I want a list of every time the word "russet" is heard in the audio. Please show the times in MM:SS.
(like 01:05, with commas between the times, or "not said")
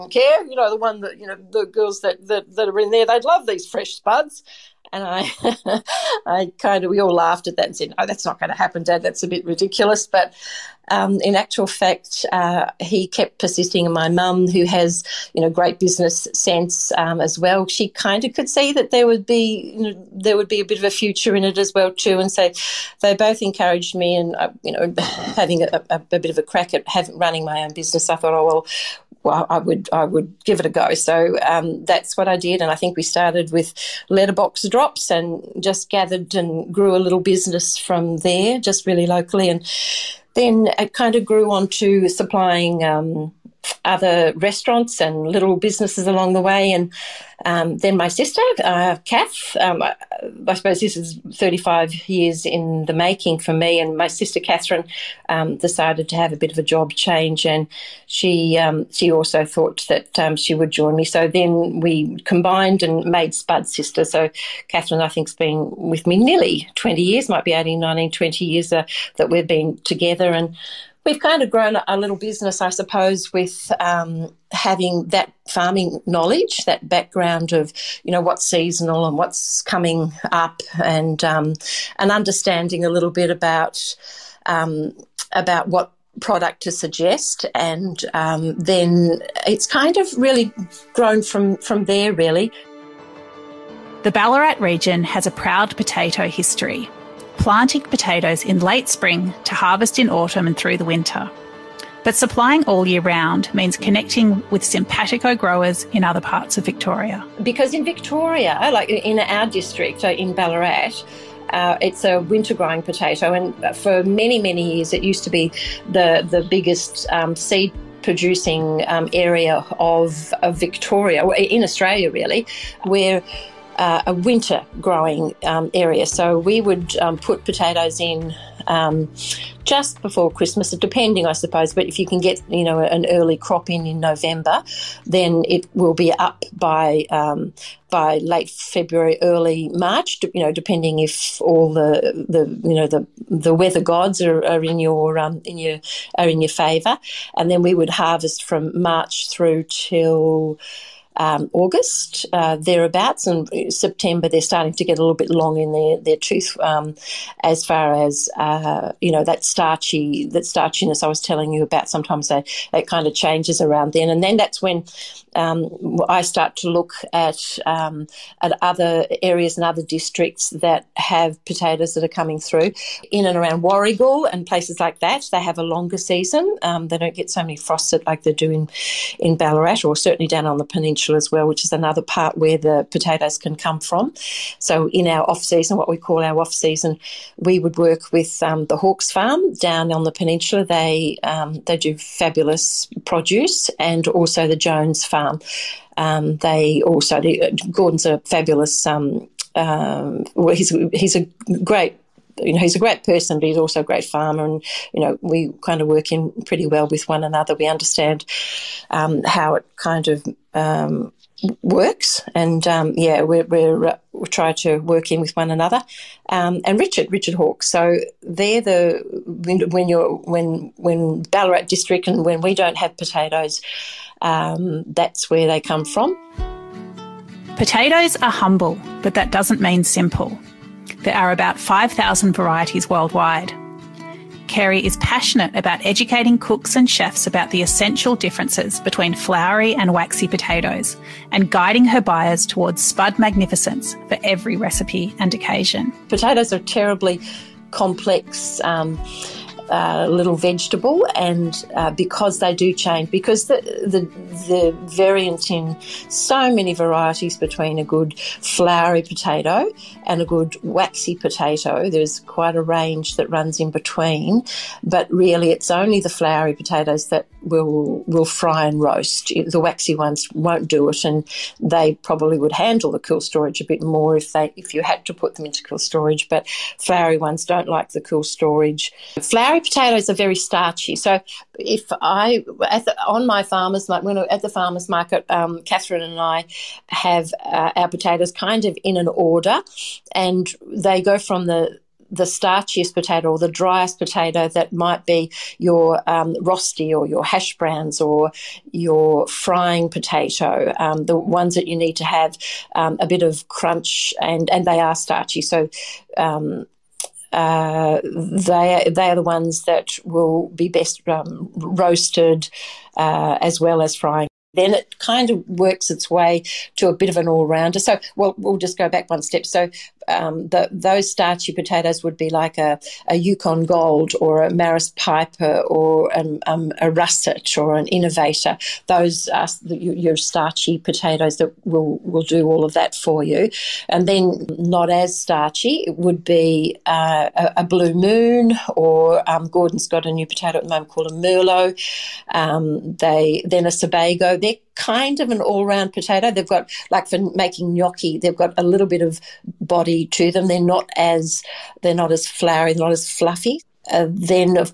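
05:26.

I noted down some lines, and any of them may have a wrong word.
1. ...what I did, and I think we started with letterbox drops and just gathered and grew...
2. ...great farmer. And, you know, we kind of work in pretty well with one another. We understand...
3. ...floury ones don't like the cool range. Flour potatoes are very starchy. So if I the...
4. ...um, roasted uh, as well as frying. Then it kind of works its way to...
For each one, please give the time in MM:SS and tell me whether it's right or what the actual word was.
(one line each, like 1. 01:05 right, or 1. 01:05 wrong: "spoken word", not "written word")
1. 00:32 right
2. 03:23 right
3. 04:36 wrong: "storage", not "range"
4. 05:11 right.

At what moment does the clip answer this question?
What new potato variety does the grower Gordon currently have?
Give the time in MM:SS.
05:41.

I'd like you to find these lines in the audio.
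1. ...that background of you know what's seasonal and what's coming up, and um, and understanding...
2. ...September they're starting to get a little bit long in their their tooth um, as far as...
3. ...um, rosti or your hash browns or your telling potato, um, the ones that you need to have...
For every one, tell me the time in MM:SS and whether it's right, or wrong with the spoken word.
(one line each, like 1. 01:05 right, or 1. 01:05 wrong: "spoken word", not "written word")
1. 01:16 right
2. 02:33 right
3. 04:56 wrong: "frying", not "telling".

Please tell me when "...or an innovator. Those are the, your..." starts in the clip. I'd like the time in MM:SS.
05:27.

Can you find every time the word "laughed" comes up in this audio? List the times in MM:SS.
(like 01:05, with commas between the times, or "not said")
00:07.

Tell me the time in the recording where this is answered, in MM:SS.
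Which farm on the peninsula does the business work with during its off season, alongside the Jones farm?
03:08.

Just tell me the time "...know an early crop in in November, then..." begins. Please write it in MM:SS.
02:12.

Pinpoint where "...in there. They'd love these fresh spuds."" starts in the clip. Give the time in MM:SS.
00:02.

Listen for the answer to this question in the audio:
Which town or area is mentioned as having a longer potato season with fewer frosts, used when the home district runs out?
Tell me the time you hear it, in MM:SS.
02:53.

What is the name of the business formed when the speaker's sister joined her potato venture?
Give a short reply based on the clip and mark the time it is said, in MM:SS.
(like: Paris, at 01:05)
Spud Sister, at 01:03.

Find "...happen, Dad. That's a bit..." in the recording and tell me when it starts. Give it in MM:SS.
00:08.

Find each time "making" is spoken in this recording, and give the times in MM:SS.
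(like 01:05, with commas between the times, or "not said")
00:52, 05:47.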